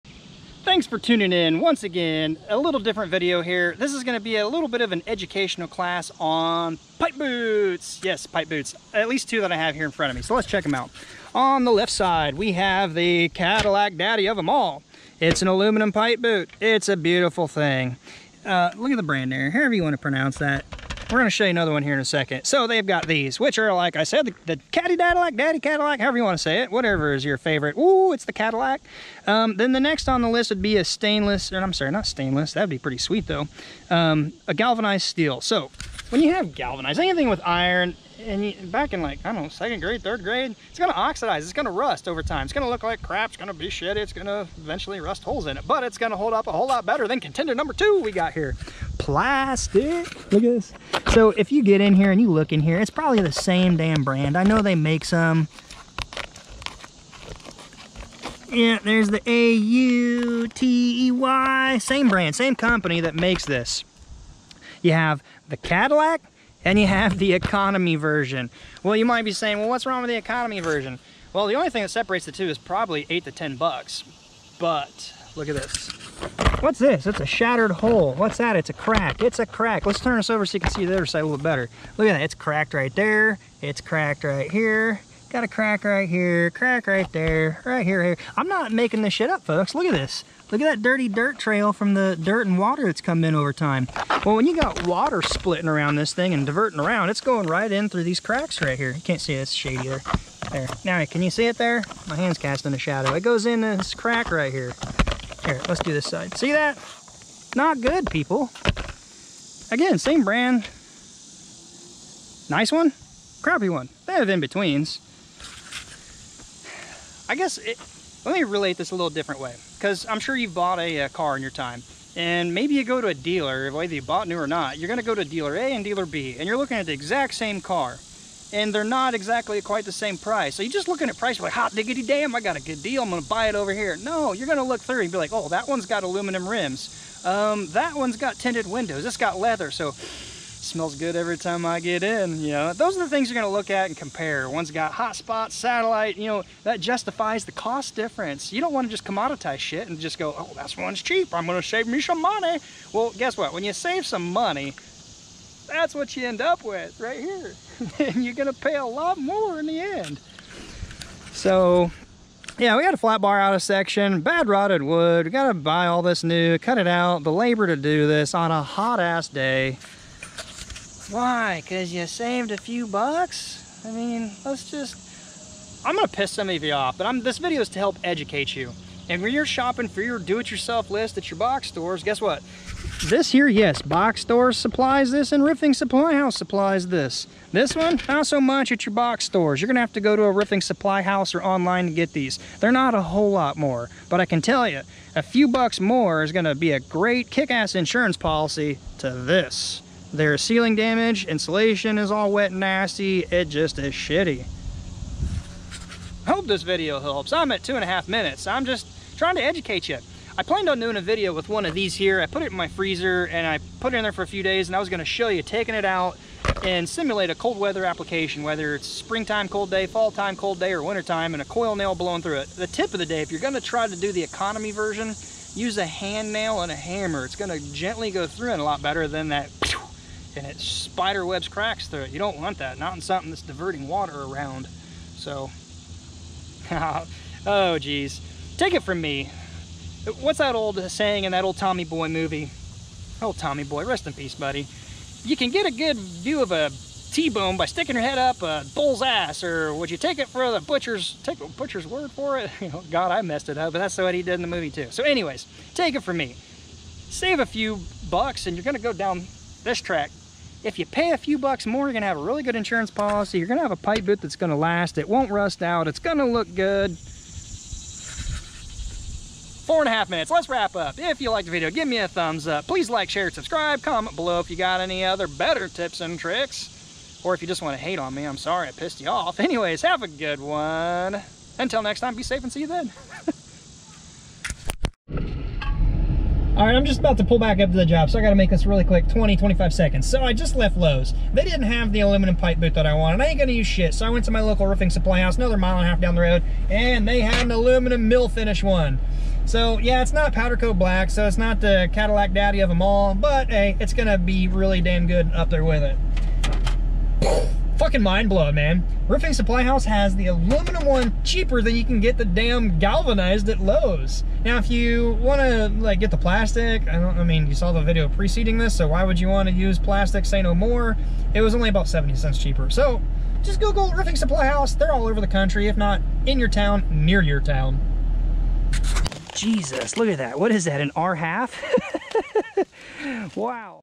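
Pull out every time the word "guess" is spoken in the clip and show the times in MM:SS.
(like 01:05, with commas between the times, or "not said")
01:57, 02:33, 03:02.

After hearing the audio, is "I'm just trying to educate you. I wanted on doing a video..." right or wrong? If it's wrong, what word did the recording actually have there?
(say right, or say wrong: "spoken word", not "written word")
wrong: "planned", not "wanted".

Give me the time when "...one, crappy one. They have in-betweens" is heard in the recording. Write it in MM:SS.
01:52.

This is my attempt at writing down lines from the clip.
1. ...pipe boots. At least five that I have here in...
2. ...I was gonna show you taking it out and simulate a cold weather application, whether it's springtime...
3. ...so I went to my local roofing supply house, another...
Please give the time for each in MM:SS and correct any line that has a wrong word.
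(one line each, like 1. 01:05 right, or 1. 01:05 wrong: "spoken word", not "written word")
1. 00:08 wrong: "two", not "five"
2. 03:34 right
3. 04:53 right.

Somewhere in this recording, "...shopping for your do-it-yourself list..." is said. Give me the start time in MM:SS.
02:59.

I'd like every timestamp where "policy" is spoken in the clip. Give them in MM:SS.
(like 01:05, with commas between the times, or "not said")
03:18, 04:22.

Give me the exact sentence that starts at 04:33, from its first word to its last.
Comment below if you got any other better tips and tricks.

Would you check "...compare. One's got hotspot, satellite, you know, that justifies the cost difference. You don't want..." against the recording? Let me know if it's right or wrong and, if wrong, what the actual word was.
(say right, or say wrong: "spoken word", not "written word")
right.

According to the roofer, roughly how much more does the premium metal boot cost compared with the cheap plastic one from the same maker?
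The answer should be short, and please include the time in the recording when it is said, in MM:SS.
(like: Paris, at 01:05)
8 to 10 bucks, at 01:13.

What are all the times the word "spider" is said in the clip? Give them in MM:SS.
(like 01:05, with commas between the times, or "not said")
03:50.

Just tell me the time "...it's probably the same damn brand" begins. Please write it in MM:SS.
00:52.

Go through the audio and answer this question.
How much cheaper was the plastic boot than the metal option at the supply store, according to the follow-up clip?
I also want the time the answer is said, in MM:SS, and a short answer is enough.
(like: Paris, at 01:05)
70 cents, at 05:21.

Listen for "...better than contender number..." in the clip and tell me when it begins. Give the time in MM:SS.
00:46.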